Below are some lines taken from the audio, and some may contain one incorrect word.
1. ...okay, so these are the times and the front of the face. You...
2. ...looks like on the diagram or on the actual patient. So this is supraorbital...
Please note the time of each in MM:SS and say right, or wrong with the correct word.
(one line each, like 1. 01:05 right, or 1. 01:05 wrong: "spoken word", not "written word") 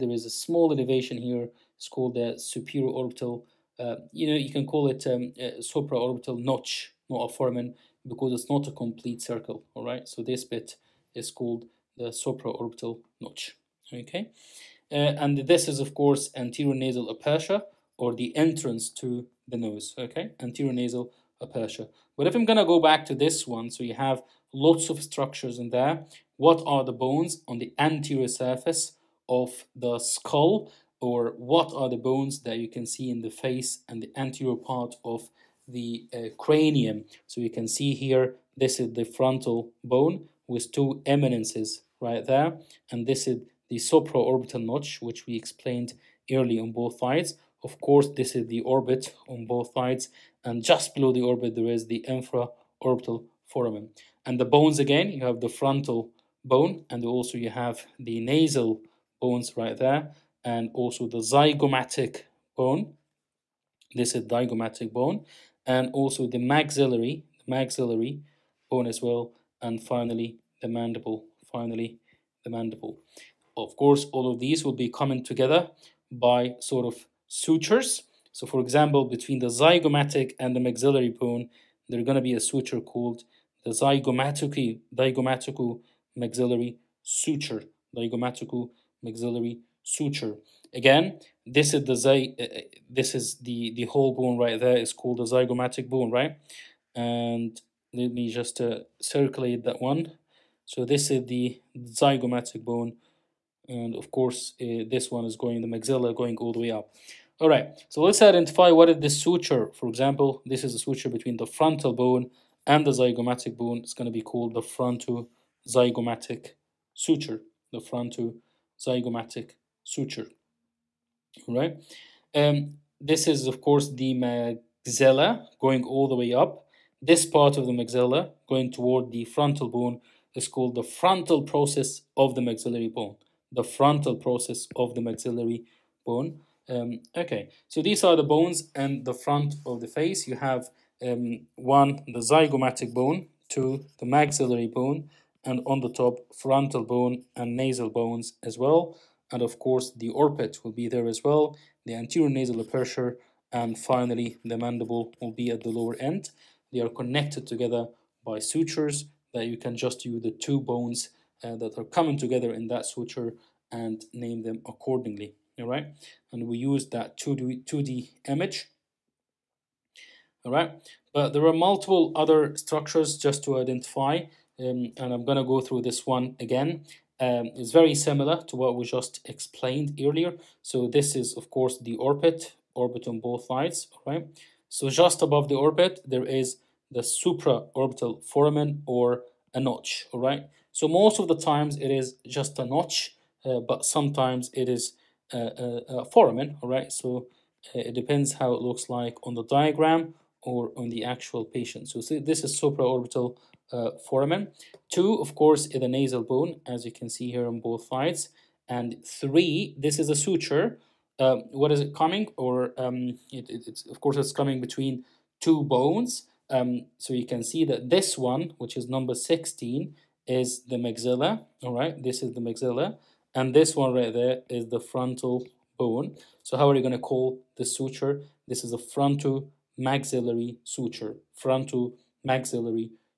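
1. 02:17 wrong: "bones", not "times"
2. 03:18 right.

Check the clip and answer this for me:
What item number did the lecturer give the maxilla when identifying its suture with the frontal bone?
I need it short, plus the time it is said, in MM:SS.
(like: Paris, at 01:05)
16, at 03:39.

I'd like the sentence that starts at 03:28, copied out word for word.
And three, this is a suture.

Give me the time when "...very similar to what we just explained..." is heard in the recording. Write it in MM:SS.
02:57.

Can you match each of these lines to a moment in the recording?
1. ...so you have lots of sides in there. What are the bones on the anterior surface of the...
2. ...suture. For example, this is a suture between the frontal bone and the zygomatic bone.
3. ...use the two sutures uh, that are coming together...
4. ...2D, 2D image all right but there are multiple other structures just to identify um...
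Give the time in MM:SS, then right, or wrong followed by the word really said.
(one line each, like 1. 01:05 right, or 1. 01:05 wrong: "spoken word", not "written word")
1. 00:23 wrong: "structures", not "sides"
2. 01:49 right
3. 02:40 wrong: "bones", not "sutures"
4. 02:47 right.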